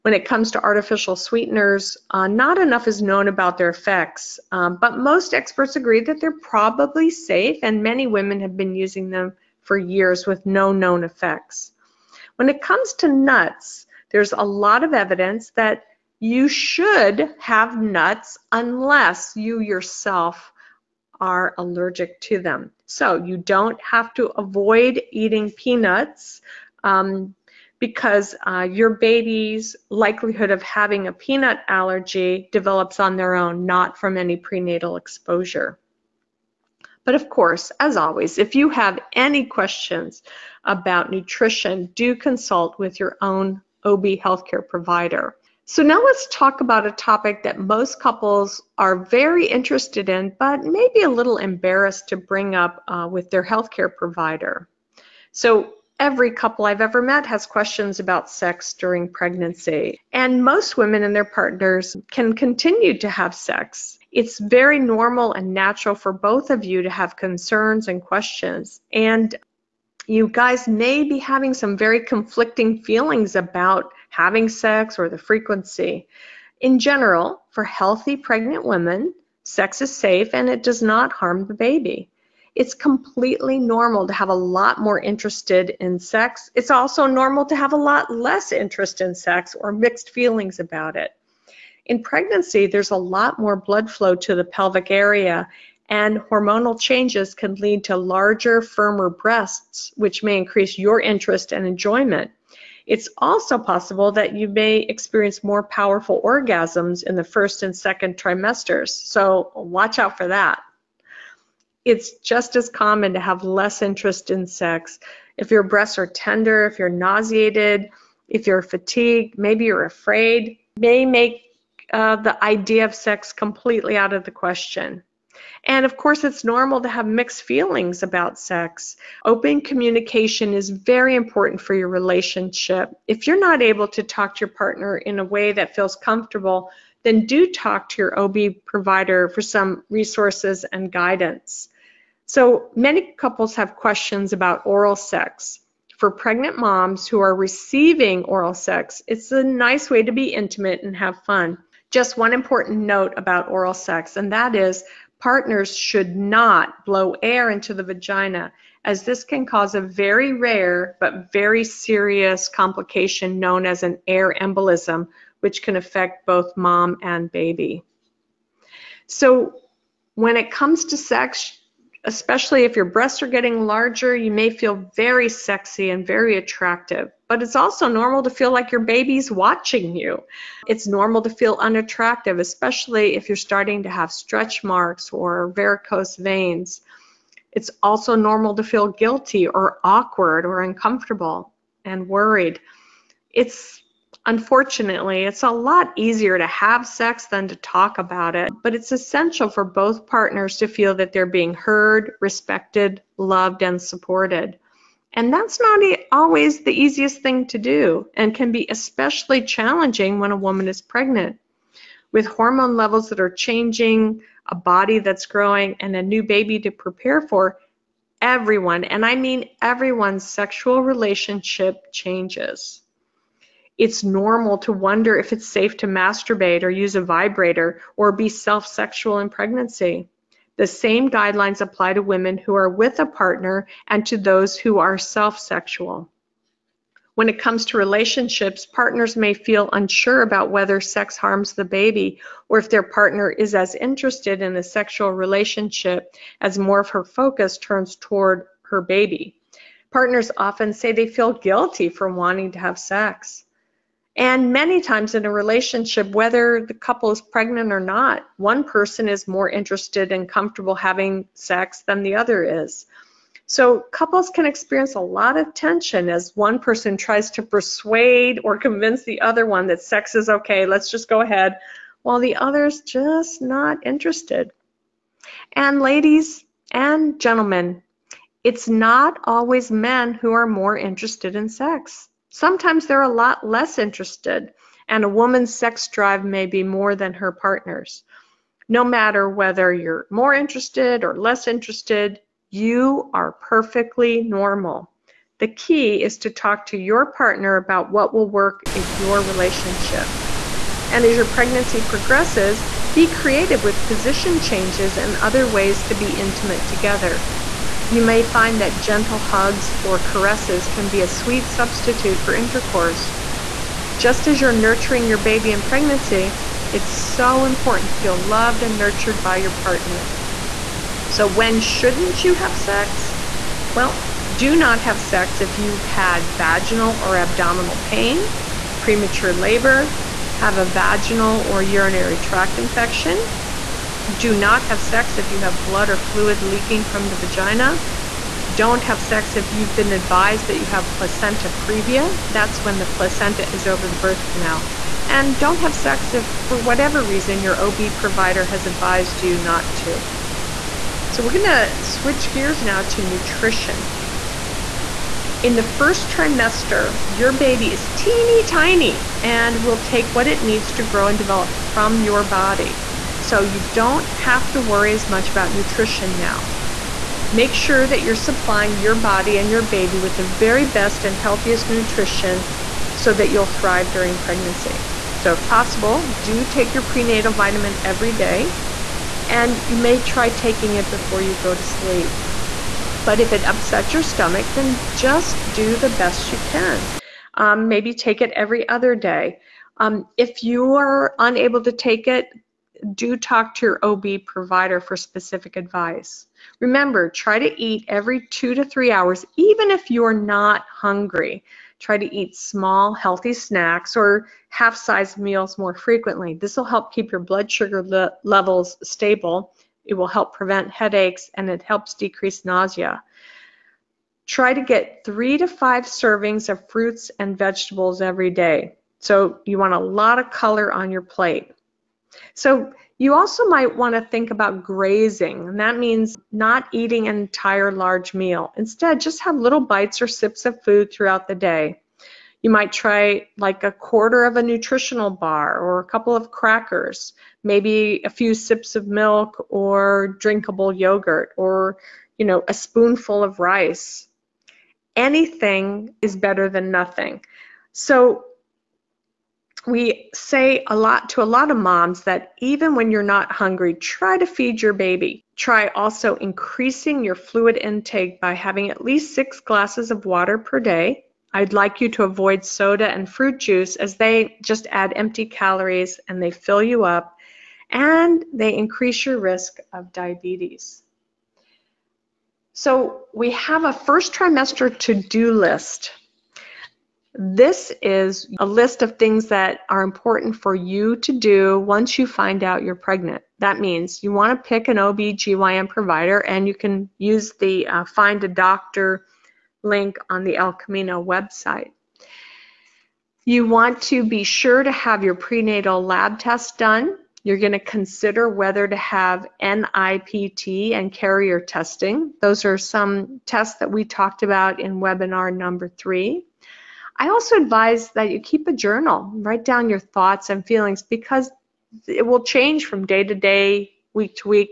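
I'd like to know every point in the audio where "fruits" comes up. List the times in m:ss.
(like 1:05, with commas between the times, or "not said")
6:56, 7:43.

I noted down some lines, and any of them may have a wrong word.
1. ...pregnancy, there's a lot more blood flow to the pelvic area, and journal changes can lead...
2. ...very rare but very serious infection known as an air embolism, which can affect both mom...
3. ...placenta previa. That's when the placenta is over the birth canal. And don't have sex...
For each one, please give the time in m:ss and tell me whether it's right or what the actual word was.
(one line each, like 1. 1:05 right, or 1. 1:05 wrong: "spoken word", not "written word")
1. 1:32 wrong: "hormonal", not "journal"
2. 2:39 wrong: "complication", not "infection"
3. 5:40 right.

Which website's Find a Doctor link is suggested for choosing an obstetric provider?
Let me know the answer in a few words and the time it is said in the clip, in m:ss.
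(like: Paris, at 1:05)
El Camino, at 8:10.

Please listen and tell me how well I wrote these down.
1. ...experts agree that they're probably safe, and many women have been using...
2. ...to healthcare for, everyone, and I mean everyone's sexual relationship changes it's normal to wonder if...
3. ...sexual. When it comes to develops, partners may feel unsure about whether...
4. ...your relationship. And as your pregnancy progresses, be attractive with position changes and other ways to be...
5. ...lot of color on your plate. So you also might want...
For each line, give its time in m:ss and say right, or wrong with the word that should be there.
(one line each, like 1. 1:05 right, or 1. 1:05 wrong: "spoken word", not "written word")
1. 0:05 right
2. 3:36 wrong: "prepare", not "healthcare"
3. 3:55 wrong: "relationships", not "develops"
4. 4:58 wrong: "creative", not "attractive"
5. 6:59 right.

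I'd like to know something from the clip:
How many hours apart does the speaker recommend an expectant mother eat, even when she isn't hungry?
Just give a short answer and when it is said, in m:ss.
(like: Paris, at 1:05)
Every 2 to 3 hours, at 6:37.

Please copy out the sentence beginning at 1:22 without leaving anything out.
It's completely normal to have a lot more interested in sex.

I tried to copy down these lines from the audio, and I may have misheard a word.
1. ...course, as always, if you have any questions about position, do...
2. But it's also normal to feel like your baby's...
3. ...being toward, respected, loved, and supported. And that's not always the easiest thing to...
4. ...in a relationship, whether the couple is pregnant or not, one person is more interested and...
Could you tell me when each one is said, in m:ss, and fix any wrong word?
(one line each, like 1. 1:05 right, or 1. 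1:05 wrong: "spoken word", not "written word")
1. 0:37 wrong: "nutrition", not "position"
2. 2:57 right
3. 3:21 wrong: "heard", not "toward"
4. 4:15 right.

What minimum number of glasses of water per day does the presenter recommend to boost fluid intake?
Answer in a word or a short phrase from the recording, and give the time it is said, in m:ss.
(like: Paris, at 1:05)
6, at 7:39.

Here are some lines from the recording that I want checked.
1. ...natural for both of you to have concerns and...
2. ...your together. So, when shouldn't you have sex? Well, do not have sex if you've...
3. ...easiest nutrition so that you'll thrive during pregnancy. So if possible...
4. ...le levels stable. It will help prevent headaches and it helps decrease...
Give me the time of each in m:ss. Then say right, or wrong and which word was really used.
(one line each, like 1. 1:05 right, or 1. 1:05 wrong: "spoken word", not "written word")
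1. 1:05 right
2. 5:19 wrong: "partner", not "together"
3. 6:11 wrong: "healthiest", not "easiest"
4. 6:47 right.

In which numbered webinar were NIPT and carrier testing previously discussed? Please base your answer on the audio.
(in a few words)
3.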